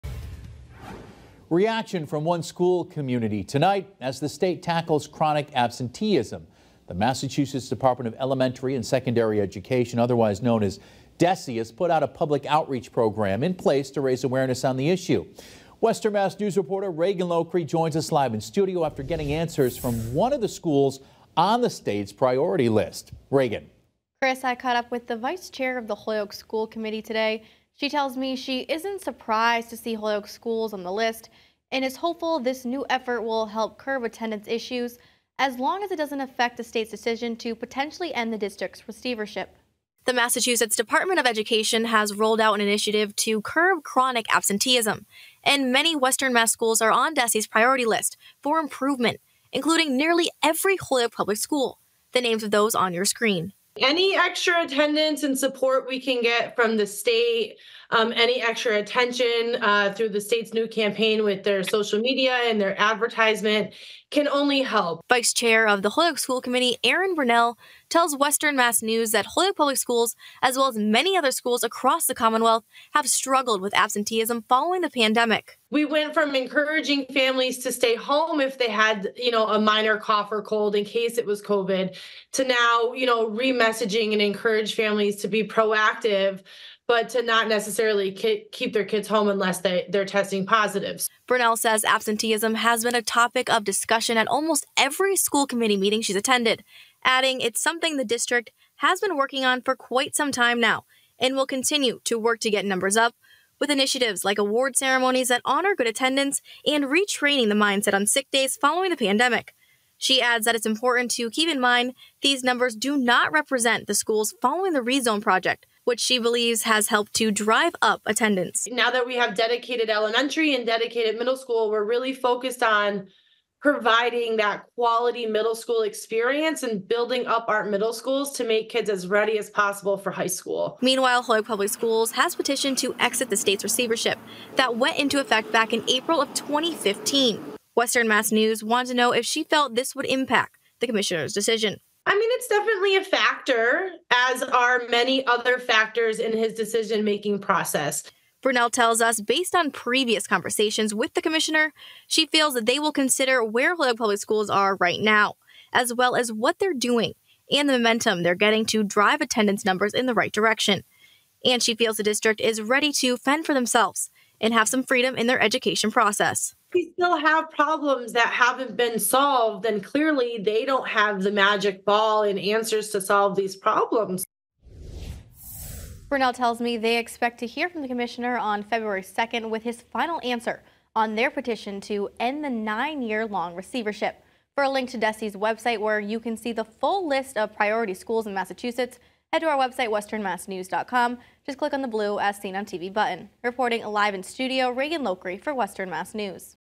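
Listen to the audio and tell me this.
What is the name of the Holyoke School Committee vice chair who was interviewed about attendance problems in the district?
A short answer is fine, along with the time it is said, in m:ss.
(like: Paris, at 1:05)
Erin Brunell, at 1:06.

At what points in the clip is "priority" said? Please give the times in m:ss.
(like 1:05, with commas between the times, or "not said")
0:22, 0:47, 3:07.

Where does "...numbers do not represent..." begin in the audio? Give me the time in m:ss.
1:52.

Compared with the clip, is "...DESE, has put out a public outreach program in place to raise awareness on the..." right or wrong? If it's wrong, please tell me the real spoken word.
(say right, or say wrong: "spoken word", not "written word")
right.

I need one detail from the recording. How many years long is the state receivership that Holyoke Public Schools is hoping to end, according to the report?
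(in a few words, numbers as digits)
9.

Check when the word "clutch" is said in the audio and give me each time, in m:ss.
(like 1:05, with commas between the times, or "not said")
not said.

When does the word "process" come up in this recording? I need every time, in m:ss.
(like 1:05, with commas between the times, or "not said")
2:27, 2:45.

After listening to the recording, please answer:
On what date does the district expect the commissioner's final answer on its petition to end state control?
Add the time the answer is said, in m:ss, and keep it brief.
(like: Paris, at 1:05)
February 2, at 2:58.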